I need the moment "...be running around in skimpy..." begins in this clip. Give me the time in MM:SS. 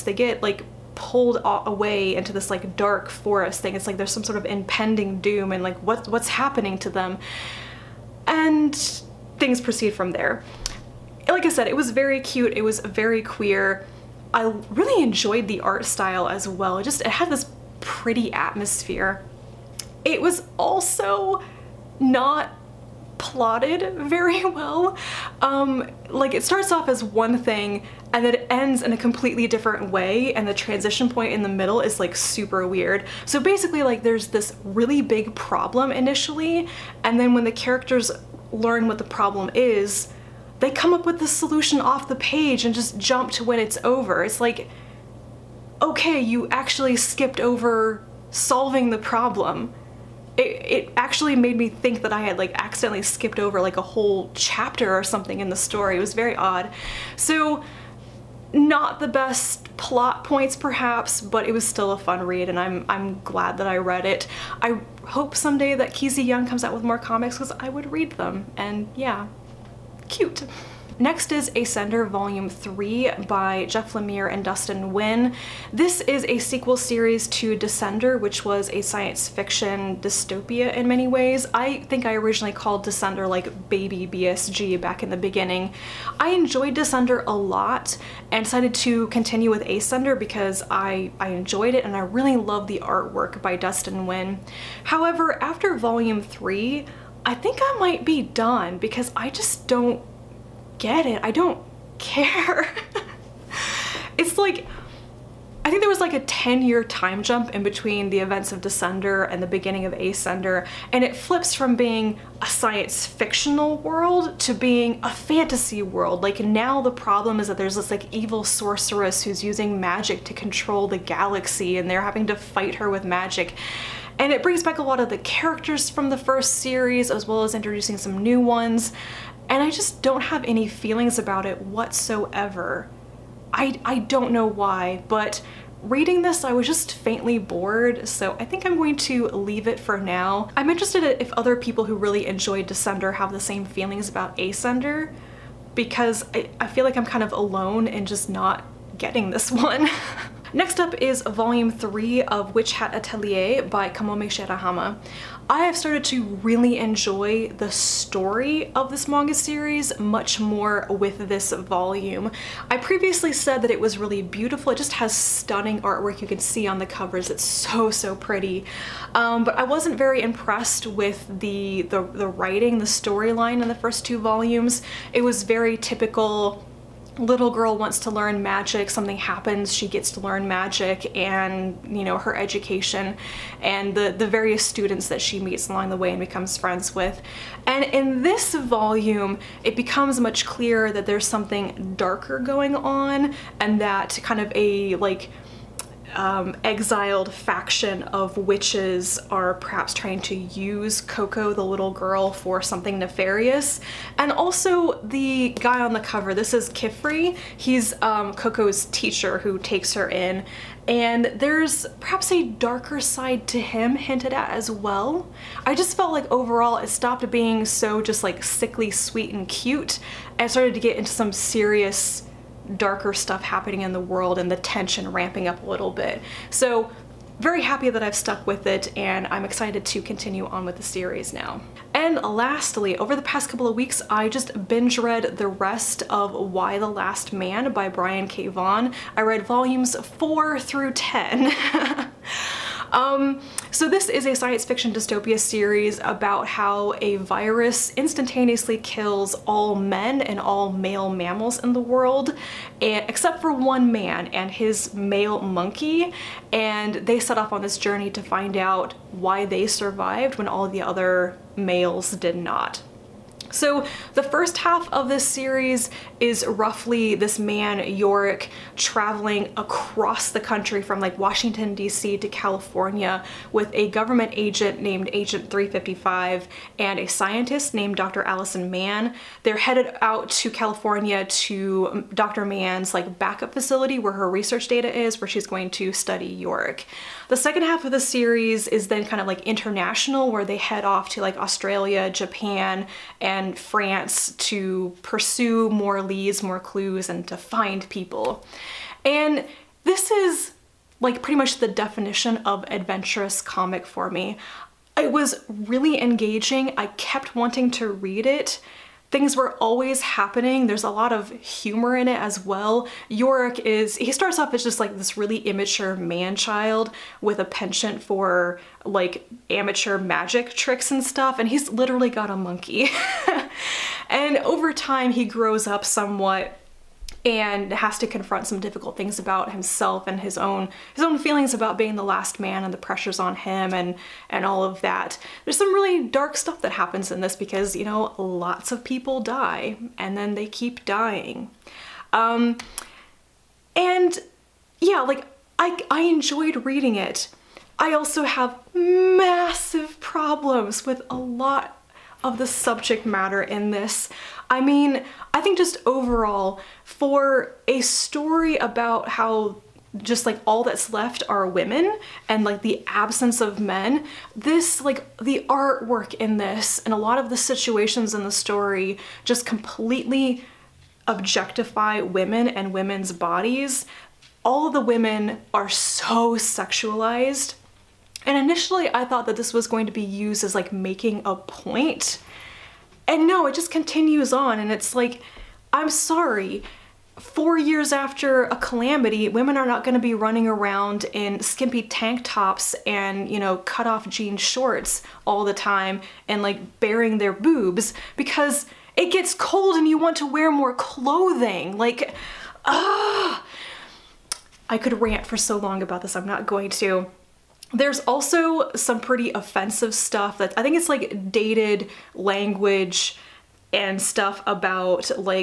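06:30.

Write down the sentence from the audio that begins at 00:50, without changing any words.
It, it, actually made me think that I had like accidentally skipped over like a whole chapter or something in the story.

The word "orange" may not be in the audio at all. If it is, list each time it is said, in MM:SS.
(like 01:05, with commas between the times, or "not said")
not said.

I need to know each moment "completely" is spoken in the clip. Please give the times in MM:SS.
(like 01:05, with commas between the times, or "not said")
00:28, 06:09.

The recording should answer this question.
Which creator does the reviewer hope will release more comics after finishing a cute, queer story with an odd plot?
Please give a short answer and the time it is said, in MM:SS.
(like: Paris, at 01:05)
Keezy Young, at 01:05.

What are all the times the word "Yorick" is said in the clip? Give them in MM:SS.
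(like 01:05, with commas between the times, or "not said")
04:27, 04:46, 05:13.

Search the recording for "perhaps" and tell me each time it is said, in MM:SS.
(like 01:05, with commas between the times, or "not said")
01:00, 03:19, 03:32.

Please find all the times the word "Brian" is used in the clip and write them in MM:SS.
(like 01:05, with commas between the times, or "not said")
03:57.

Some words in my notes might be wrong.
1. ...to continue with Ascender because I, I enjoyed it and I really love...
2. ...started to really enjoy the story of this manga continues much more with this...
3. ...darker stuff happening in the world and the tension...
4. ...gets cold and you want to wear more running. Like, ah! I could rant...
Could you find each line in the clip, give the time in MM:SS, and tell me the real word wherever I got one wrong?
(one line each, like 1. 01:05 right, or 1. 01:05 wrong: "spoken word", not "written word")
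1. 01:28 right
2. 02:35 wrong: "series", not "continues"
3. 03:42 right
4. 06:39 wrong: "clothing", not "running".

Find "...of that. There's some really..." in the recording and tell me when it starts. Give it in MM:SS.
05:34.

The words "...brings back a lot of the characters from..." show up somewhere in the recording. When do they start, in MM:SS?
02:04.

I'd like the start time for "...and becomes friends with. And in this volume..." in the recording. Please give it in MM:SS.
03:06.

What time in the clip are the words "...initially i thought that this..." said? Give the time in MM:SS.
06:18.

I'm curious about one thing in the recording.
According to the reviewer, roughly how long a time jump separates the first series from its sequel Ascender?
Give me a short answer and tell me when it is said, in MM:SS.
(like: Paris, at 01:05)
10 year, at 01:46.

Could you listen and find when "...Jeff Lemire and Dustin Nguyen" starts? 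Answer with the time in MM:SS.
01:13.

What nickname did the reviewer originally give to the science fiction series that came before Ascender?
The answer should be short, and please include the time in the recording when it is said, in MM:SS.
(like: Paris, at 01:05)
baby BSG, at 01:23.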